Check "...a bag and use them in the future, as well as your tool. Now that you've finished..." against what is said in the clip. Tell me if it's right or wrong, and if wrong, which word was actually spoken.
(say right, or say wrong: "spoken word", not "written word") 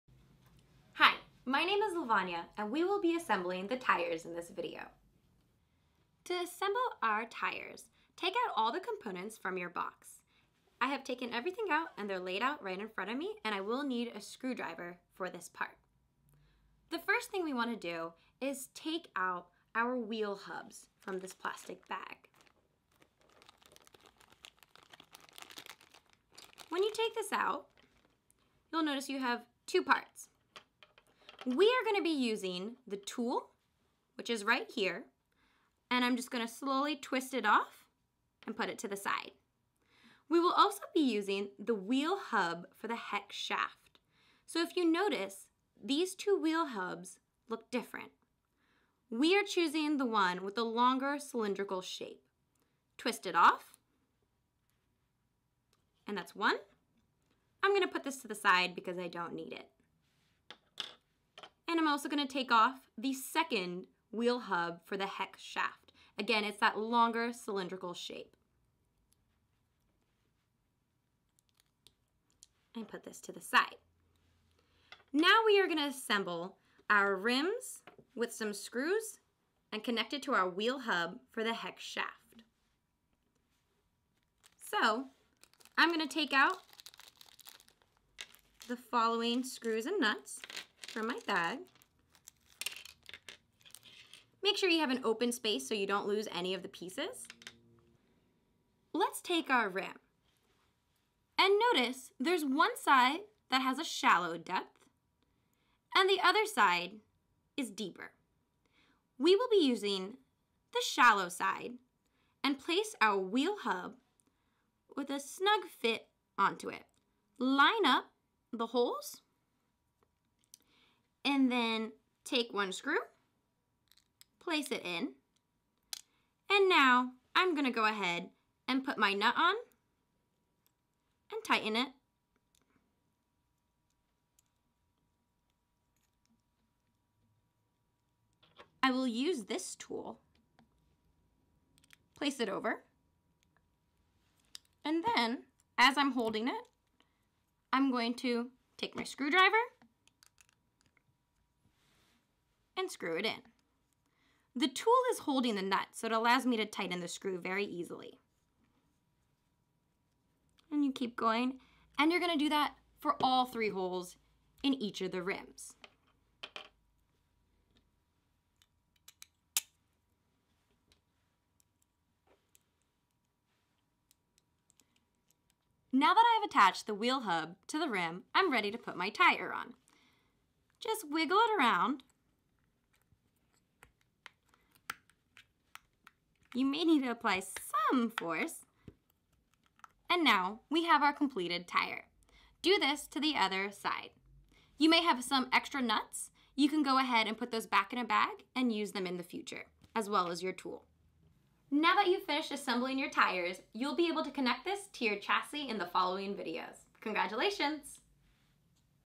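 right.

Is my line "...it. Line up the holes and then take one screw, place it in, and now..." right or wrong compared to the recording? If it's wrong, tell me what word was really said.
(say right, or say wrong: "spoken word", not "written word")
right.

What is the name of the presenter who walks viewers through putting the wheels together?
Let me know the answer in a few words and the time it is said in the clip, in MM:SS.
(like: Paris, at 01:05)
Lavanya, at 00:01.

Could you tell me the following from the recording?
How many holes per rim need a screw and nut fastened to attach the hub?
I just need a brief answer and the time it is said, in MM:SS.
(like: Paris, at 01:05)
3, at 02:43.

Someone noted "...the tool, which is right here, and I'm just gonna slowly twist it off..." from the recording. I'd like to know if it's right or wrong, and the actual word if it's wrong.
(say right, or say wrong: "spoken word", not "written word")
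right.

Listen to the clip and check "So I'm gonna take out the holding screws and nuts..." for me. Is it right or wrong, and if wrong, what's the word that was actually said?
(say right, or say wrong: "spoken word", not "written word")
wrong: "following", not "holding".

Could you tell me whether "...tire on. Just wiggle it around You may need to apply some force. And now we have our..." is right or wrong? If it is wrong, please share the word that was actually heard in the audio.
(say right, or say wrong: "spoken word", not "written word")
right.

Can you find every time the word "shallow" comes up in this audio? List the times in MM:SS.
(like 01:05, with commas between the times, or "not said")
01:43, 01:50.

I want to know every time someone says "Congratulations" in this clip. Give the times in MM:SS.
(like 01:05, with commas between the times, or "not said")
03:26.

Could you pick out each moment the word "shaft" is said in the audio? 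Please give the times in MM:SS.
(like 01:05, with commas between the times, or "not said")
00:43, 01:05, 01:21.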